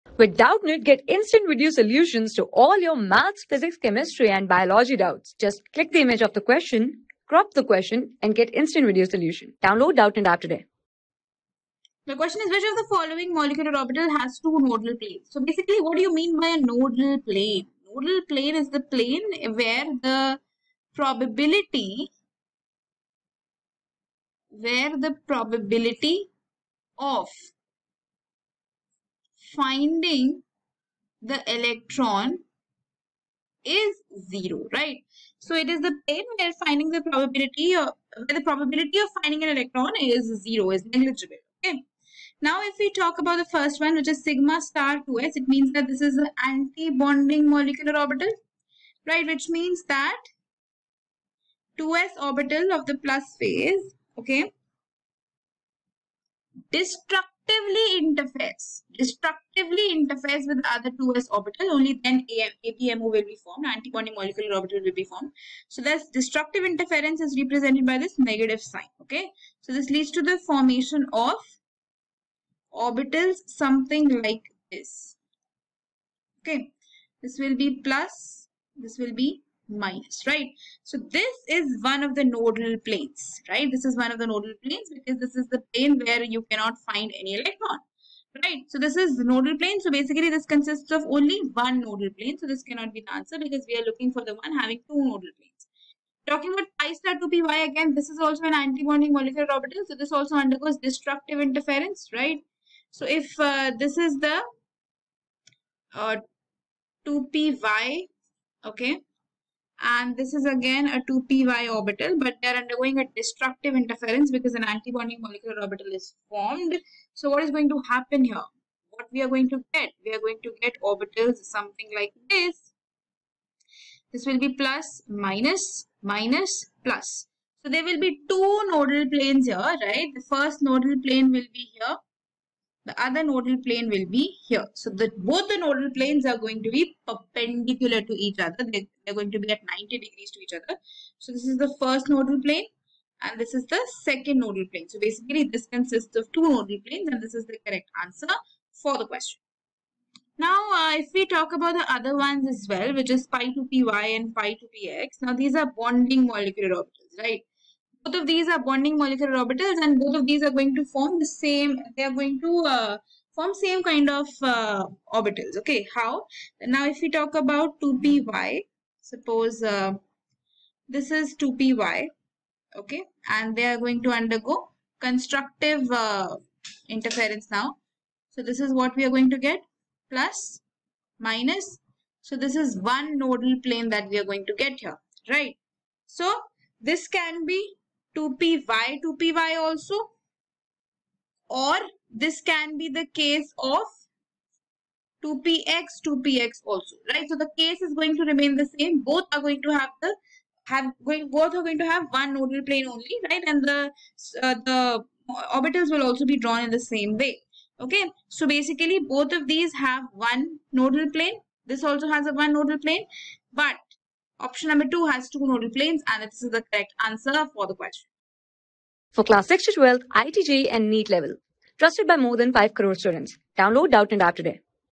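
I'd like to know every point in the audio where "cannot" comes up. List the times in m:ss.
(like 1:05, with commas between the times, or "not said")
1:26, 1:32.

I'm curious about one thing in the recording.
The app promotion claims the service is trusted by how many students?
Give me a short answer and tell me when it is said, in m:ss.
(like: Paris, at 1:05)
more than 5 crore, at 3:42.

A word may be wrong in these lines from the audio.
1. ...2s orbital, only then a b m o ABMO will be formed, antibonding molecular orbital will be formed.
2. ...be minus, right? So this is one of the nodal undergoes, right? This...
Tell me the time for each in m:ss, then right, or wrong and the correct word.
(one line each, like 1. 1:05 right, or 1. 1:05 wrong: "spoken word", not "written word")
1. 1:00 right
2. 1:19 wrong: "planes", not "undergoes".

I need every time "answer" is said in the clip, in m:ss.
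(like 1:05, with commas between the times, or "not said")
1:33, 2:28, 3:37.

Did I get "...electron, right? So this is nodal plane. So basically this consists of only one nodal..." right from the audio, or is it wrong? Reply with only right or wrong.
right.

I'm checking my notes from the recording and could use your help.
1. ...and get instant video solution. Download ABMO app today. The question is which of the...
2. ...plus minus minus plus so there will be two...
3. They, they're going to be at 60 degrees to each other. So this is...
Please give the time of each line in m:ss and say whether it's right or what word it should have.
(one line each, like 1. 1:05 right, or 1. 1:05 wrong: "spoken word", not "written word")
1. 0:08 wrong: "Doubtnut", not "ABMO"
2. 2:04 right
3. 2:18 wrong: "90", not "60".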